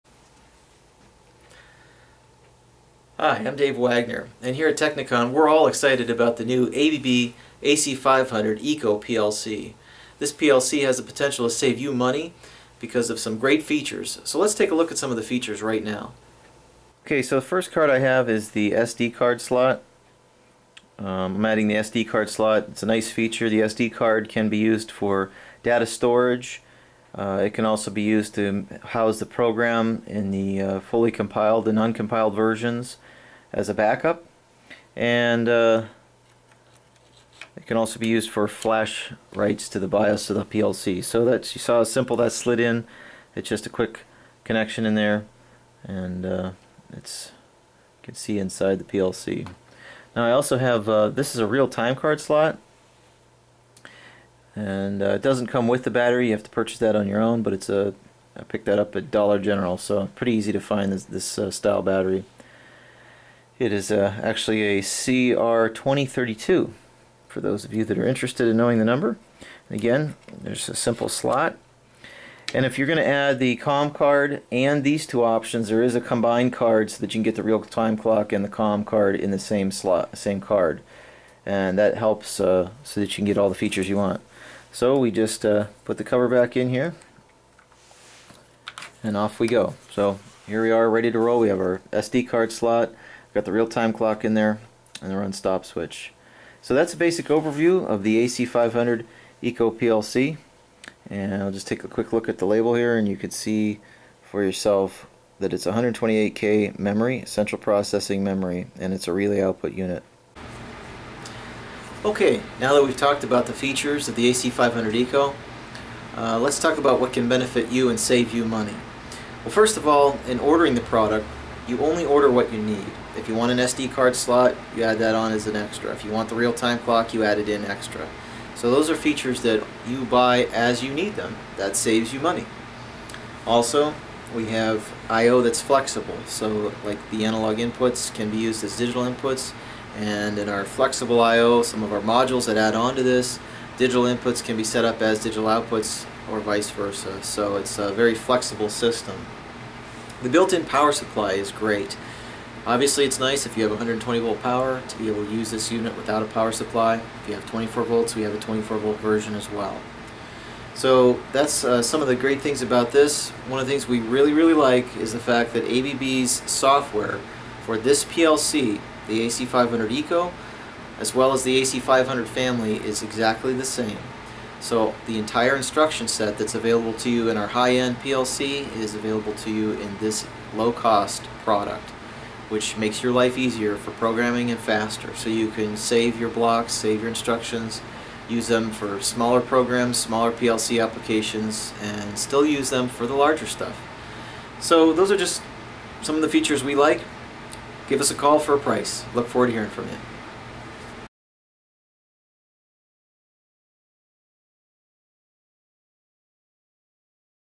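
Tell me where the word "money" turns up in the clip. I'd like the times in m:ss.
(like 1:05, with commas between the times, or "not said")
0:11, 1:58, 2:12.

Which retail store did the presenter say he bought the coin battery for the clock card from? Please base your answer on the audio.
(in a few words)
Dollar General.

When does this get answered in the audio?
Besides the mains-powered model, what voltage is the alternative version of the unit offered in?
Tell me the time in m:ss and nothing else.
2:38.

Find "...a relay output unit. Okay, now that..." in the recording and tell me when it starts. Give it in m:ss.
1:49.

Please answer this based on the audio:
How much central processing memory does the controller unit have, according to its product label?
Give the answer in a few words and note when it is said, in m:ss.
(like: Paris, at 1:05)
128K, at 1:45.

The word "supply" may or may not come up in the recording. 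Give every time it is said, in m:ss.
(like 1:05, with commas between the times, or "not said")
2:30, 2:36.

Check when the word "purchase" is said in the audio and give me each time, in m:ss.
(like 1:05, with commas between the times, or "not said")
0:56.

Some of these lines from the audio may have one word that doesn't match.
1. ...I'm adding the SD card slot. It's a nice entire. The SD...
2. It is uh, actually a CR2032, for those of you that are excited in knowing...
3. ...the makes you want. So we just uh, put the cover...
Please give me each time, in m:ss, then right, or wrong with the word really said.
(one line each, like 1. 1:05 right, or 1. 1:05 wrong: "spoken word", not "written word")
1. 0:21 wrong: "feature", not "entire"
2. 1:03 wrong: "interested", not "excited"
3. 1:23 wrong: "features", not "makes".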